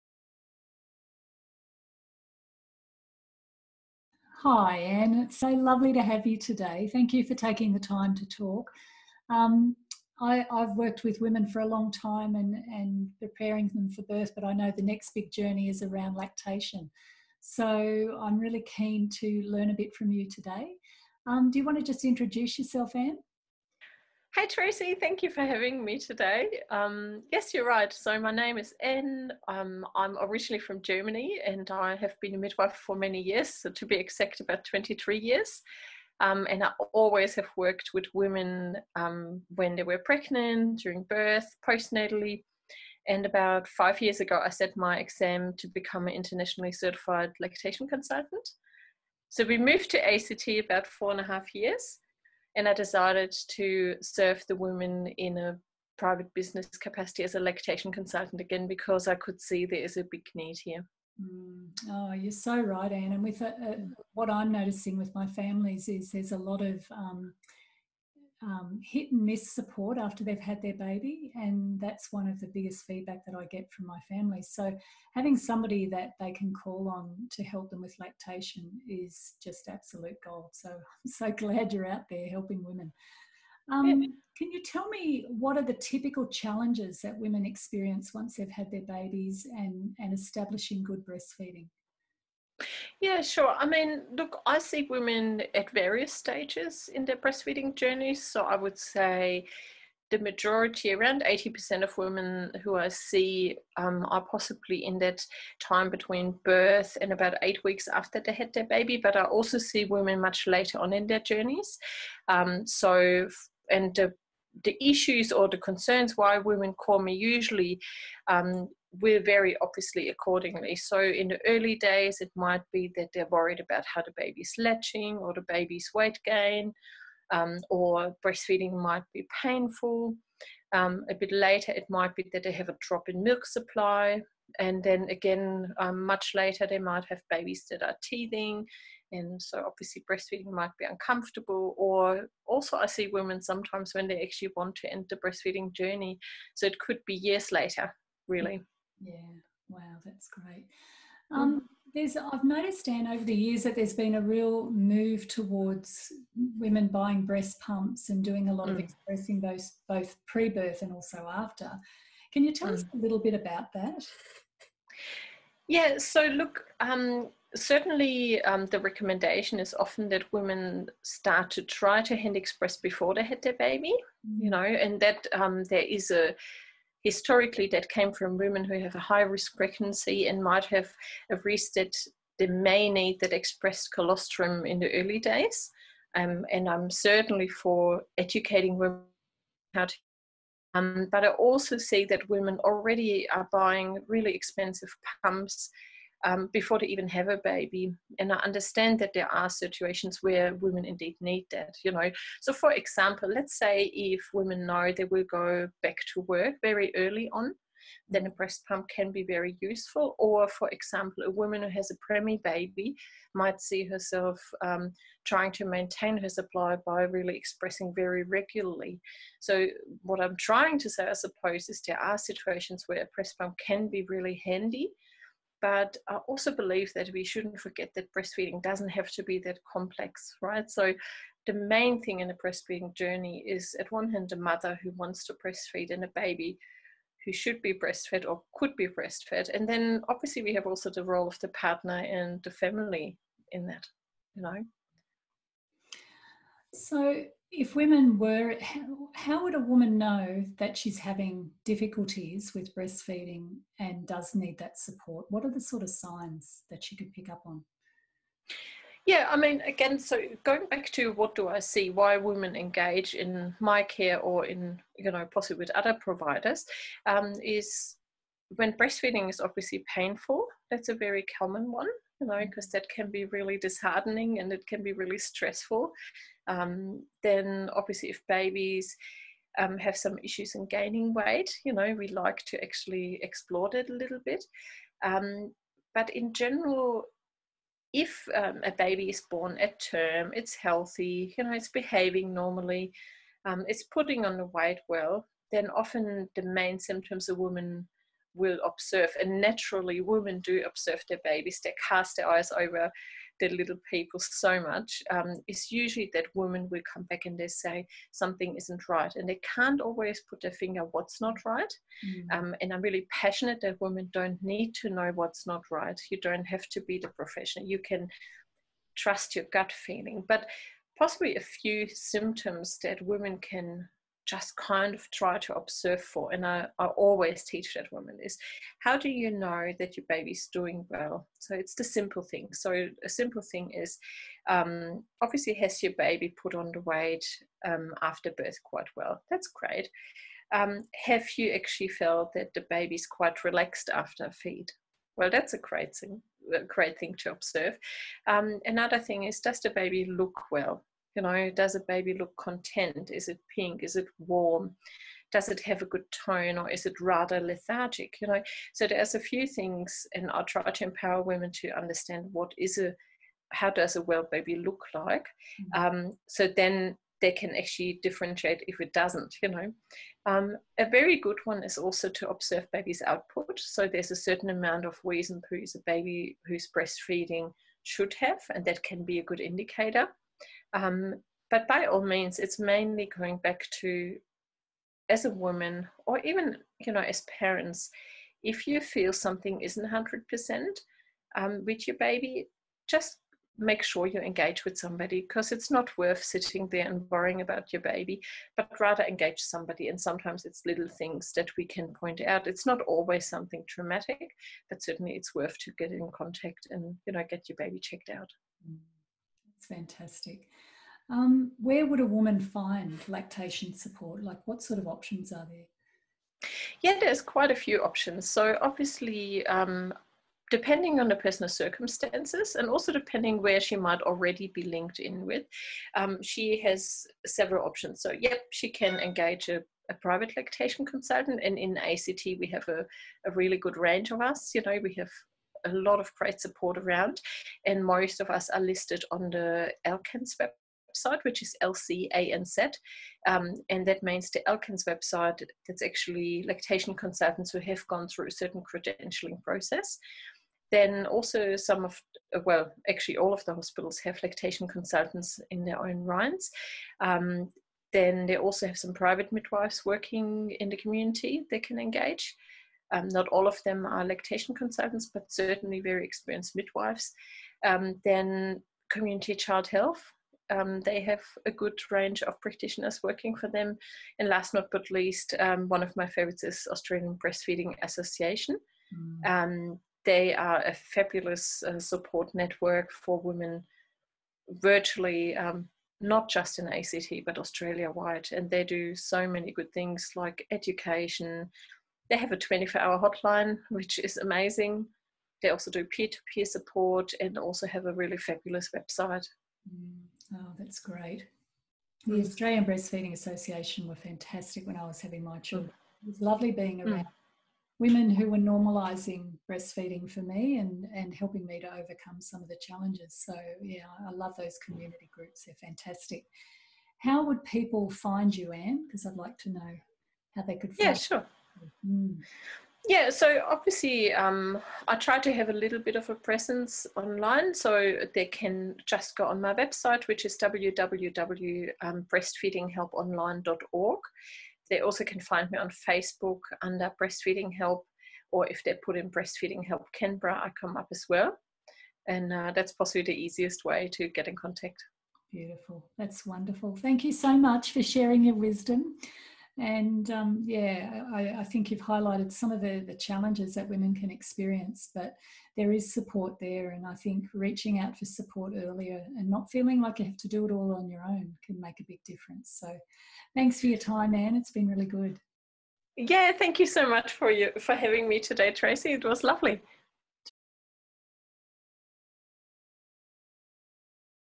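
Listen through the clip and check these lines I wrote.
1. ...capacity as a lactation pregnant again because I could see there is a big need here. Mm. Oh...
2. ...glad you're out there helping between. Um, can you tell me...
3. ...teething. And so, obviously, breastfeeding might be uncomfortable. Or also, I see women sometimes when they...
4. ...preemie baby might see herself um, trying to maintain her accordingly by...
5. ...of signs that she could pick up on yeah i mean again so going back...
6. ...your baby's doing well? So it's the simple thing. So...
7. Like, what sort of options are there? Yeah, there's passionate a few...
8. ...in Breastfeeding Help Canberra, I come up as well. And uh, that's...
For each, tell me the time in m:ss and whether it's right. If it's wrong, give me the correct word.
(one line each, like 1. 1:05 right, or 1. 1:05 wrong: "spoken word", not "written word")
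1. 0:56 wrong: "consultant", not "pregnant"
2. 1:21 wrong: "women", not "between"
3. 2:18 right
4. 3:32 wrong: "supply", not "accordingly"
5. 4:15 right
6. 5:29 right
7. 6:54 wrong: "quite", not "passionate"
8. 8:58 right.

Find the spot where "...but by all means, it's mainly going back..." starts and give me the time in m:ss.
6:21.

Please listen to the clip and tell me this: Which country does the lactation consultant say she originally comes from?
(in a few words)
Germany.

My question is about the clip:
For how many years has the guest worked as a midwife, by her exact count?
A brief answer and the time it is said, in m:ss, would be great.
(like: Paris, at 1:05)
23, at 0:34.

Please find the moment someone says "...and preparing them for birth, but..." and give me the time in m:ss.
0:12.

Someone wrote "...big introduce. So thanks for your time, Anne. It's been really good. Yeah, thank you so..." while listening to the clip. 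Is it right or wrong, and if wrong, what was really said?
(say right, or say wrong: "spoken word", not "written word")
wrong: "difference", not "introduce".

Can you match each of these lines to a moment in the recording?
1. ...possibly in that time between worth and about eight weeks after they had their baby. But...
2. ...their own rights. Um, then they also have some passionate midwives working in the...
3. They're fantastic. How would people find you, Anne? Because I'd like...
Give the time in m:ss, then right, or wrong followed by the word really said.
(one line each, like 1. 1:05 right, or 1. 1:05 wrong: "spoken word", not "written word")
1. 1:44 wrong: "birth", not "worth"
2. 7:35 wrong: "private", not "passionate"
3. 8:35 right.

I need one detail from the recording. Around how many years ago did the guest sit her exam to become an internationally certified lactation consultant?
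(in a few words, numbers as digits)
5.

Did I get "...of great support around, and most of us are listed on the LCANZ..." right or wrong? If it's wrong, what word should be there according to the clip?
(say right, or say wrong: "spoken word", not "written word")
right.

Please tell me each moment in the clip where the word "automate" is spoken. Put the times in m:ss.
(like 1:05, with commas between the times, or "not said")
not said.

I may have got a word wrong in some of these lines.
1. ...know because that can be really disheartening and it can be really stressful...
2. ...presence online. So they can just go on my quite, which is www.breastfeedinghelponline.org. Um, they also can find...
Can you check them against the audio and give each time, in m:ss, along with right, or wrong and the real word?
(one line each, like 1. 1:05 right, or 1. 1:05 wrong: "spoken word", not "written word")
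1. 4:32 right
2. 8:46 wrong: "website", not "quite".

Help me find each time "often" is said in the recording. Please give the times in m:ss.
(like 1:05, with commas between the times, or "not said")
2:49, 4:55.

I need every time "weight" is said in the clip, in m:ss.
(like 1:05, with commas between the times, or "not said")
2:05, 4:41, 4:54, 5:36.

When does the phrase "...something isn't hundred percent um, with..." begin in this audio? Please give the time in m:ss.
6:29.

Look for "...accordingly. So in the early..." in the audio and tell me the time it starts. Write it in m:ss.
2:00.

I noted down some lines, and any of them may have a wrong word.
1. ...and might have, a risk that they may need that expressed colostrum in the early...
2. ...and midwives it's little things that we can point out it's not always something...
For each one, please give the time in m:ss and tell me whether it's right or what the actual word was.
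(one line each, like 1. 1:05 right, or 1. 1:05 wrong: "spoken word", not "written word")
1. 3:00 right
2. 6:39 wrong: "sometimes", not "midwives".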